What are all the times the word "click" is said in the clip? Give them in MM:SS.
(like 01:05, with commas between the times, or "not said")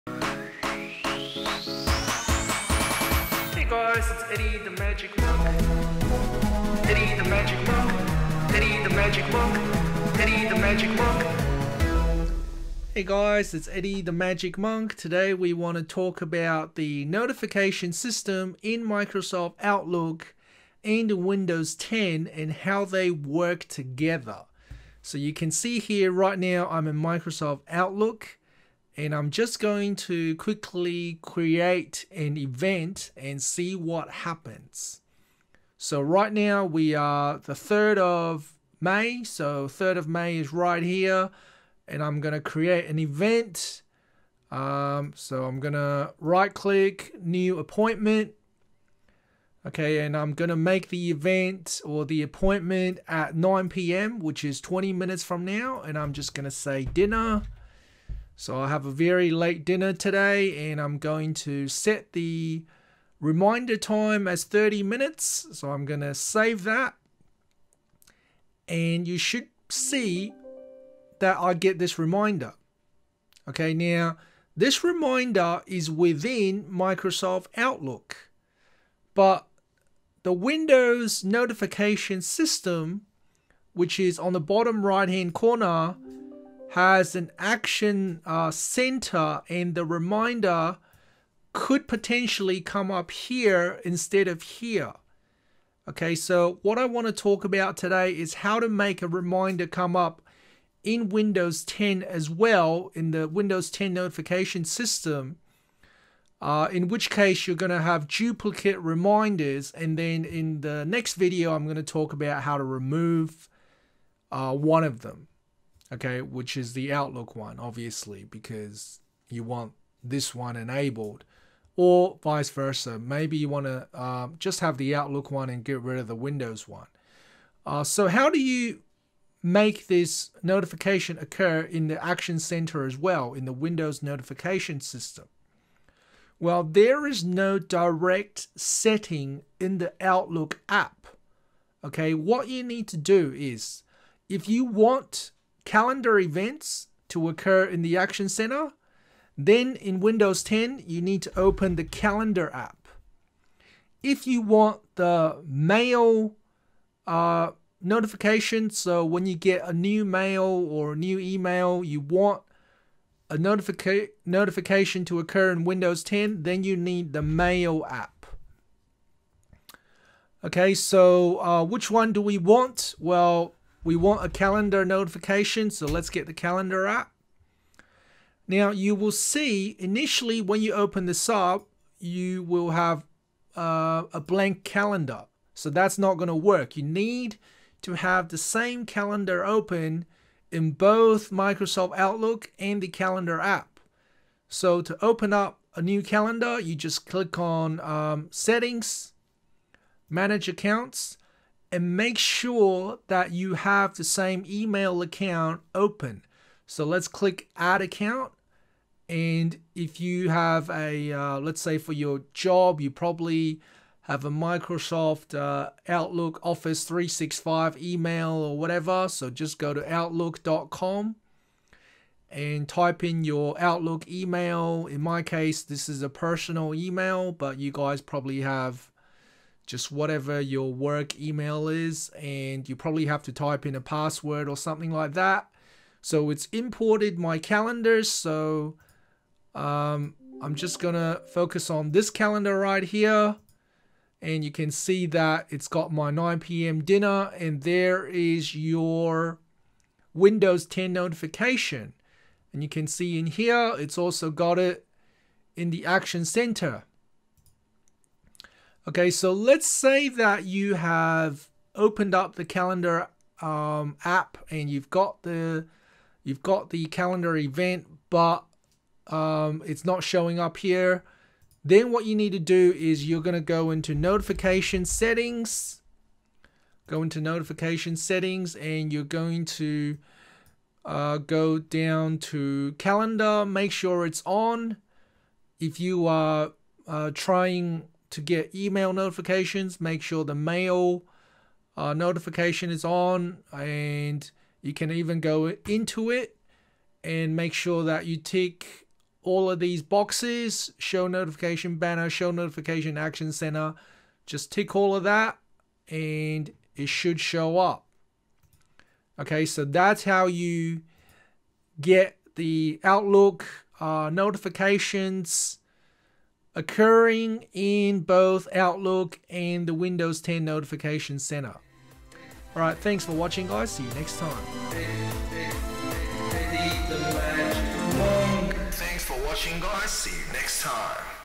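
00:46, 03:17, 03:27.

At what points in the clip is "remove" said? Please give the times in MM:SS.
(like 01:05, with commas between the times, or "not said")
01:52.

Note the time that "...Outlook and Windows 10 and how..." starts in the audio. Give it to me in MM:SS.
00:19.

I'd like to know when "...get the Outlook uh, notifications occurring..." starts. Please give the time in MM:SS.
05:11.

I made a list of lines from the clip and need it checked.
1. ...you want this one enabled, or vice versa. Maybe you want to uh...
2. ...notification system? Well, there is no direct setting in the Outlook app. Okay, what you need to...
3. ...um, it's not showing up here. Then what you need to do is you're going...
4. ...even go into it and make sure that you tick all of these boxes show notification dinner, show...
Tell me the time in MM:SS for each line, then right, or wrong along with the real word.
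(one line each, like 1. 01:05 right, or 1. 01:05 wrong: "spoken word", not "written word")
1. 01:59 right
2. 02:14 right
3. 04:29 right
4. 04:54 wrong: "banner", not "dinner".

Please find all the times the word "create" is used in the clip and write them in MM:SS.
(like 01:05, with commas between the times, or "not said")
00:31, 00:42.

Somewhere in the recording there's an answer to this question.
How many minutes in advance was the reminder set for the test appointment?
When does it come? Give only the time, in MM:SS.
01:04.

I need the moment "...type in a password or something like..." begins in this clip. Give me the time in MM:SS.
03:53.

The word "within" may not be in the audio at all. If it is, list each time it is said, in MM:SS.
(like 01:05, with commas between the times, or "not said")
01:15.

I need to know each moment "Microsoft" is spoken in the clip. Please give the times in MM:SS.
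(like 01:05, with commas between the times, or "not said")
00:18, 00:26, 01:16, 03:11, 03:34.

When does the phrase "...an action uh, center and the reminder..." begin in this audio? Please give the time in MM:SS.
01:27.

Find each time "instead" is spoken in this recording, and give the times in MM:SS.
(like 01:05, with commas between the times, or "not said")
01:33.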